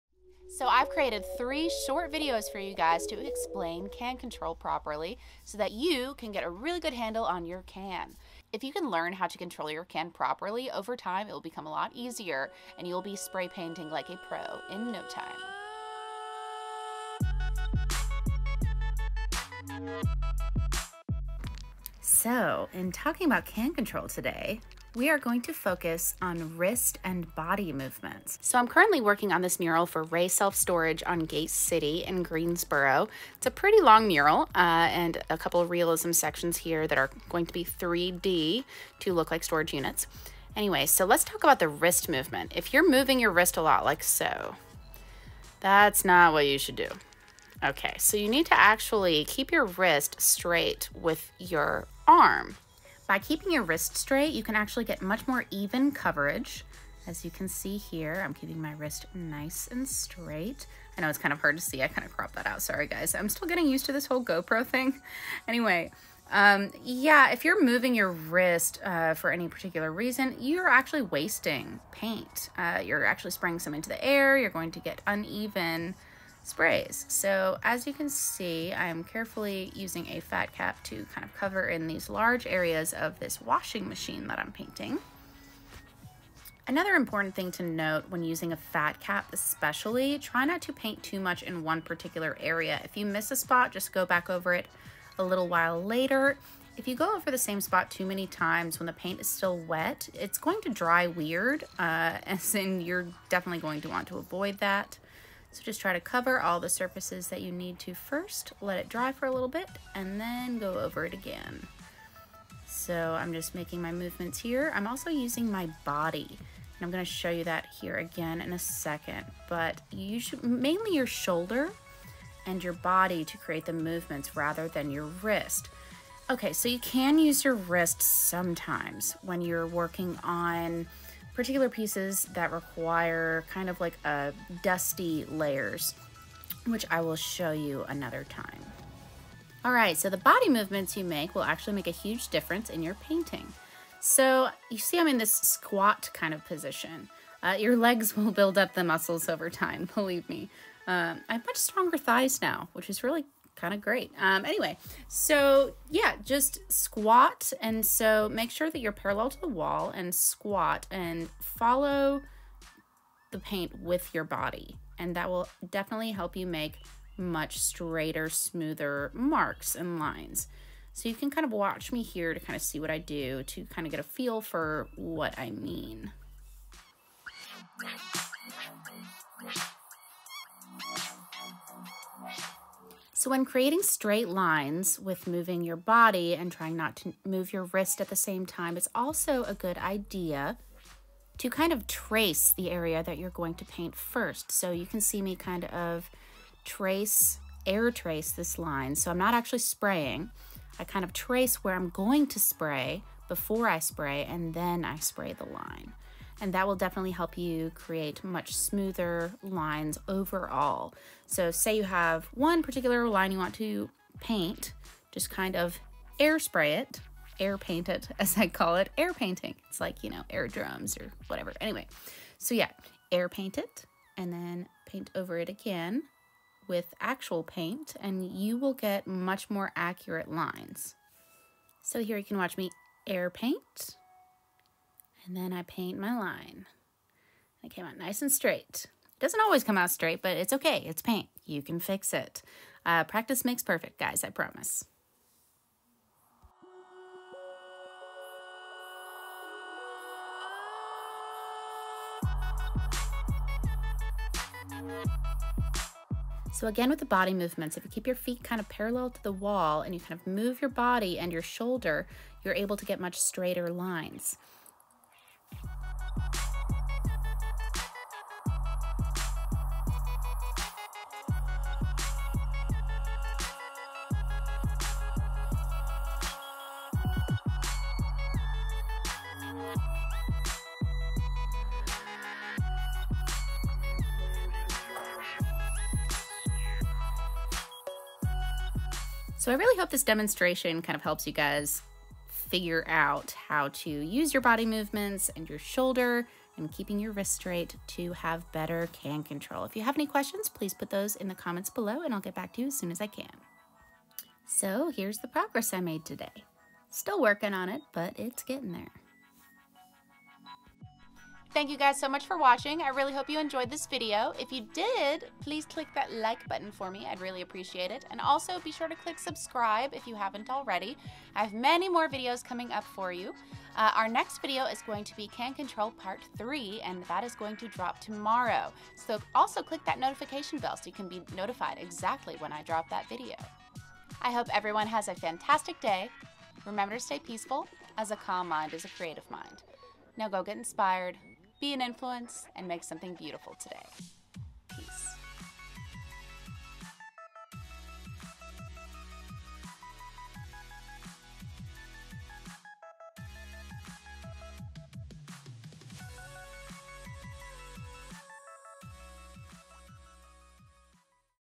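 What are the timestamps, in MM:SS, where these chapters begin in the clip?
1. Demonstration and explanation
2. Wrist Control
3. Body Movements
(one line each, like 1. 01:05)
1. 00:25
2. 00:39
3. 01:55.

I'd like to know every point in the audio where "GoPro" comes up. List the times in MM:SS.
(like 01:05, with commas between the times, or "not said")
01:04.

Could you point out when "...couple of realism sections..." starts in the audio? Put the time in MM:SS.
00:35.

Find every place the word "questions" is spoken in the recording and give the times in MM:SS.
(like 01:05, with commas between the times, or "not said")
05:00.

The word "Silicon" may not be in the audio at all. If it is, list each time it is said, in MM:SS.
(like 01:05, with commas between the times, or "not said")
not said.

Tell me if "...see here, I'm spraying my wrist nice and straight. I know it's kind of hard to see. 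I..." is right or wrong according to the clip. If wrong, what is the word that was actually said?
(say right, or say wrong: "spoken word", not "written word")
wrong: "keeping", not "spraying".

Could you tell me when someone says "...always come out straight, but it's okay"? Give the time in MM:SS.
03:59.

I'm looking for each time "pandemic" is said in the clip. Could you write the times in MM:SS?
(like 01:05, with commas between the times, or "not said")
not said.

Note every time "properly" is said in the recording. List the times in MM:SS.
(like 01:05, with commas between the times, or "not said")
00:04, 00:10.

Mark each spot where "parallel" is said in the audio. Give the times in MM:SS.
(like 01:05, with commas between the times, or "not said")
02:38, 04:18.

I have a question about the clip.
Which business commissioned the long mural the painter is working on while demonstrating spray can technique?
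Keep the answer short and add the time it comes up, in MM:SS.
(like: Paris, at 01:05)
Ray Self Storage, at 00:30.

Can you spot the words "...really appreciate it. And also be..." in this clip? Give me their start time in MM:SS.
05:17.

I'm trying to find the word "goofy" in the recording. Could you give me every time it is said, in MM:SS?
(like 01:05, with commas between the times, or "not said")
not said.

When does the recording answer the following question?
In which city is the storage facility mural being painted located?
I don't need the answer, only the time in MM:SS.
00:32.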